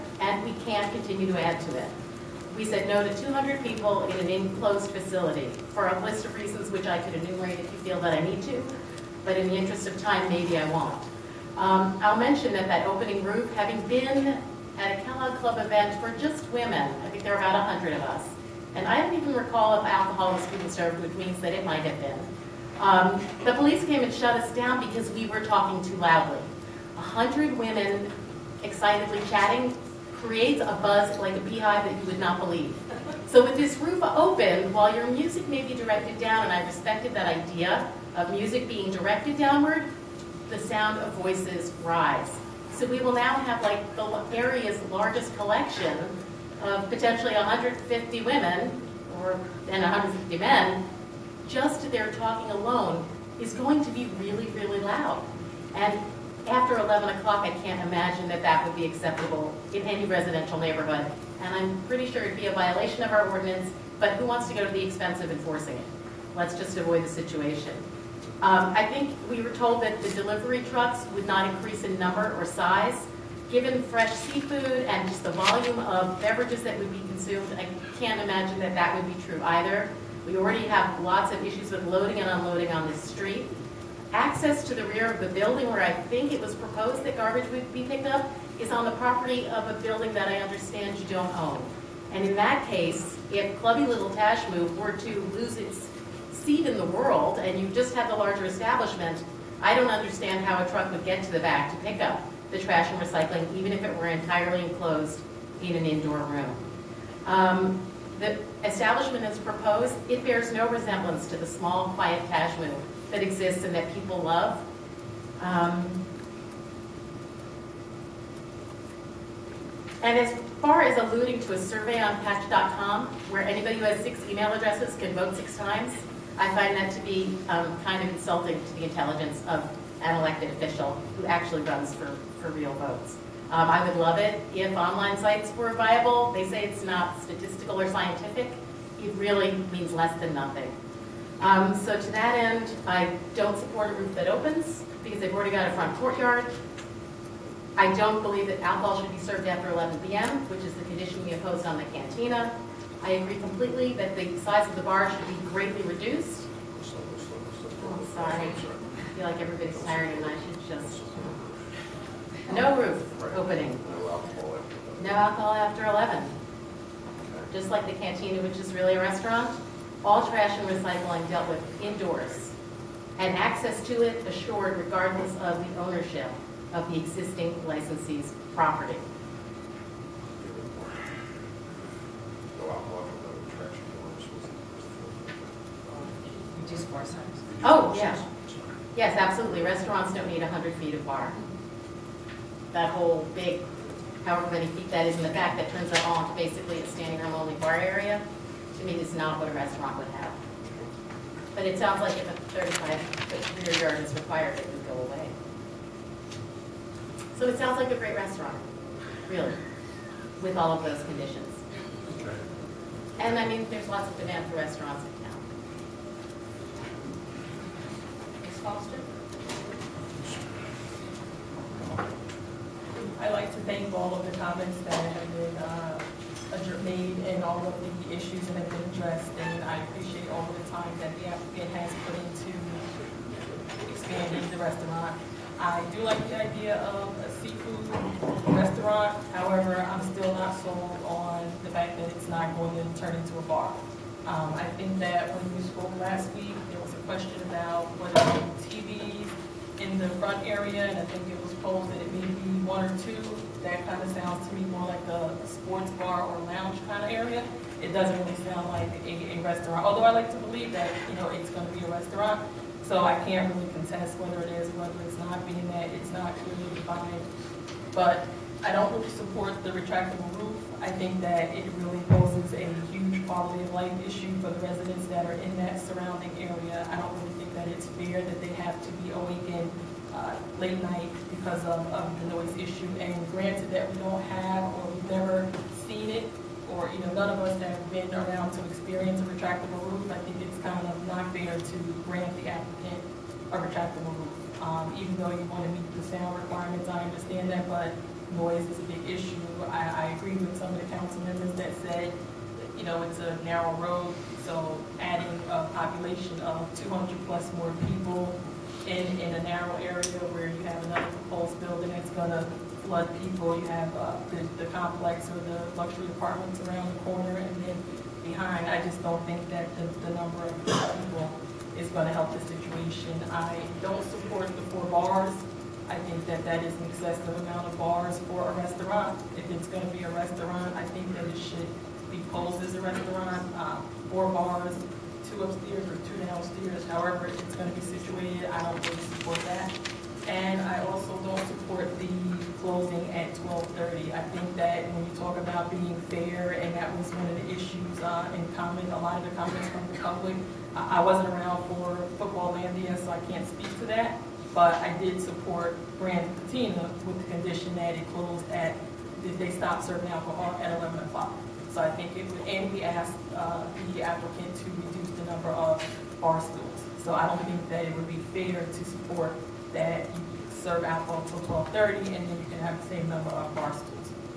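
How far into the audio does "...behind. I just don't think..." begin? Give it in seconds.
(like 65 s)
318 s.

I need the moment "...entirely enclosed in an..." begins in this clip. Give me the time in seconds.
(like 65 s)
104 s.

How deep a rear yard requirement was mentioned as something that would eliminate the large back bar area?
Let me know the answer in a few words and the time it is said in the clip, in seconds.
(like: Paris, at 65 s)
35 feet, at 202 s.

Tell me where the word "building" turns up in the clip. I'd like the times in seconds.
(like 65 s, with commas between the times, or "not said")
85 s, 89 s, 311 s.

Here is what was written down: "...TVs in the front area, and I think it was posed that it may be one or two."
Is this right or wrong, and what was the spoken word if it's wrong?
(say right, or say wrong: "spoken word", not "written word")
right.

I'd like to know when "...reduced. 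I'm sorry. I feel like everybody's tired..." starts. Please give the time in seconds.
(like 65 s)
155 s.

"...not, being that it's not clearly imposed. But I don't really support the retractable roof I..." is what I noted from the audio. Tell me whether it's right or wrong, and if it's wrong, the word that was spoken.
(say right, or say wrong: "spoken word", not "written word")
wrong: "defined", not "imposed".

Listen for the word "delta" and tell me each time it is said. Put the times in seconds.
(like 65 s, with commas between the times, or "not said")
not said.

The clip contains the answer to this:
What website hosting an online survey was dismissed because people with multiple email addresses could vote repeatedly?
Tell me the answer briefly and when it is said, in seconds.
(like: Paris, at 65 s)
patch.com, at 122 s.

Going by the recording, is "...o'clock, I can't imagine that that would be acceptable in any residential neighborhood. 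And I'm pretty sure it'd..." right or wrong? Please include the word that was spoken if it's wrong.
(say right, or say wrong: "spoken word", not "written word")
right.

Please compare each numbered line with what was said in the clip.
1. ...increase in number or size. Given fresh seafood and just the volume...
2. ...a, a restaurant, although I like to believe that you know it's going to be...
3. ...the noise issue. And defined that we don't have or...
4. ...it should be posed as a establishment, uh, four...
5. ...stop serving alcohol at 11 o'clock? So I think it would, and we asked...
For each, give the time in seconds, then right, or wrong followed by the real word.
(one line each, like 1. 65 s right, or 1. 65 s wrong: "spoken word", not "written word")
1. 71 s right
2. 259 s right
3. 282 s wrong: "granted", not "defined"
4. 331 s wrong: "restaurant", not "establishment"
5. 359 s right.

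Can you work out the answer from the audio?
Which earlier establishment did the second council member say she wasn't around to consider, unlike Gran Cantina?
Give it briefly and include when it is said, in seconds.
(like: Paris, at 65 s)
Futbol-Landia, at 352 s.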